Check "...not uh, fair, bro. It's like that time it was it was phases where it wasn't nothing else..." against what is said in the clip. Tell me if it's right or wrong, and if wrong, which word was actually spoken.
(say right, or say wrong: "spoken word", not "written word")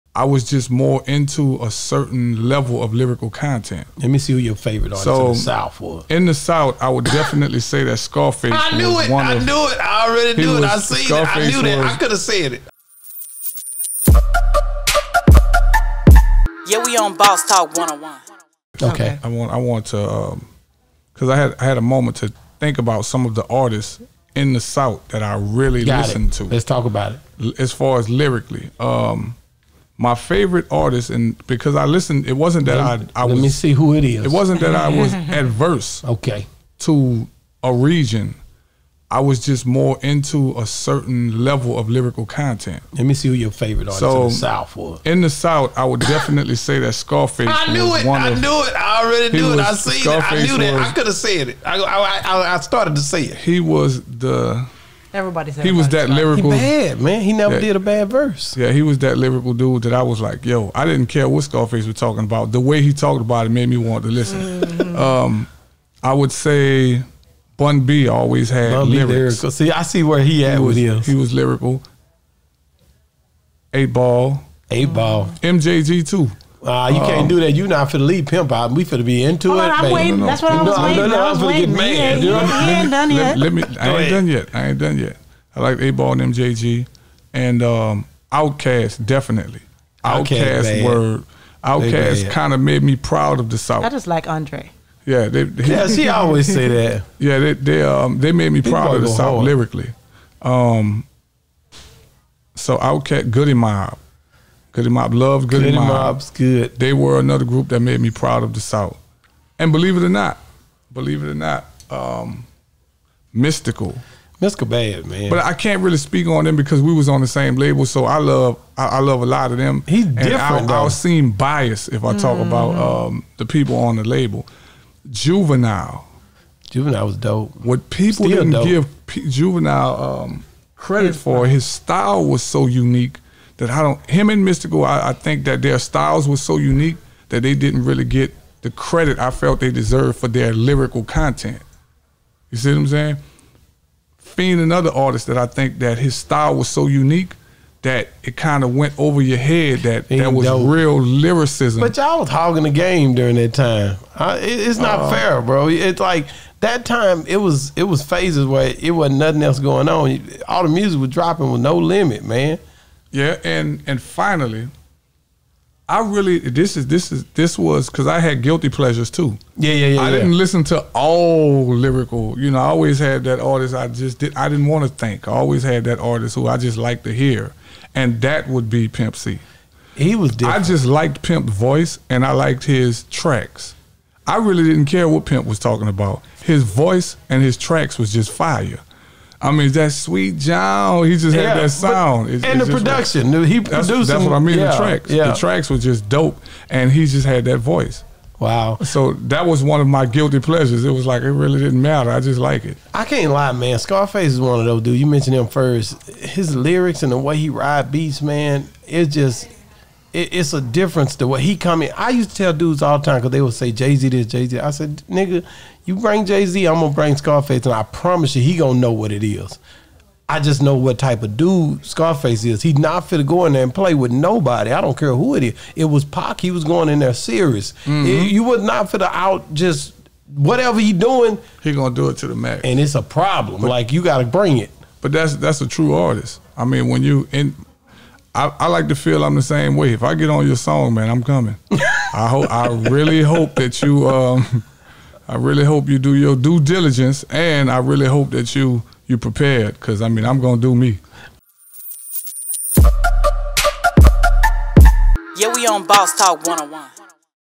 right.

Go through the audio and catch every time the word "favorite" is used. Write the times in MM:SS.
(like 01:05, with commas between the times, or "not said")
00:04, 00:30, 00:43.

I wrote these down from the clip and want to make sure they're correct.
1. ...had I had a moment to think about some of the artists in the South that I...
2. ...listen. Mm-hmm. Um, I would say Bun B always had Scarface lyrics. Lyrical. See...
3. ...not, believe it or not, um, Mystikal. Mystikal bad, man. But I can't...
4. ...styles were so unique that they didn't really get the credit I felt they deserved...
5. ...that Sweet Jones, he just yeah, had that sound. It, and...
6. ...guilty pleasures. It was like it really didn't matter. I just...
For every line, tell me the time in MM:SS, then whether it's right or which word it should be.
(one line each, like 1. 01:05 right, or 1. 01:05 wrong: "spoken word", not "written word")
1. 00:21 right
2. 01:04 wrong: "Bun", not "Scarface"
3. 01:50 right
4. 02:15 right
5. 03:09 right
6. 03:20 right.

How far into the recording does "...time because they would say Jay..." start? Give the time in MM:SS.
03:33.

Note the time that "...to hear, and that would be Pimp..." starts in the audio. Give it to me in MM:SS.
02:57.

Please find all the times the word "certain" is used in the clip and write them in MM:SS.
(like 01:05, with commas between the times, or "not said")
00:01, 00:40.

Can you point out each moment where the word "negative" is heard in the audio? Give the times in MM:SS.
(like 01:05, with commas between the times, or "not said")
not said.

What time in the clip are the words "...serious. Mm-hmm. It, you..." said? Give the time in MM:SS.
03:47.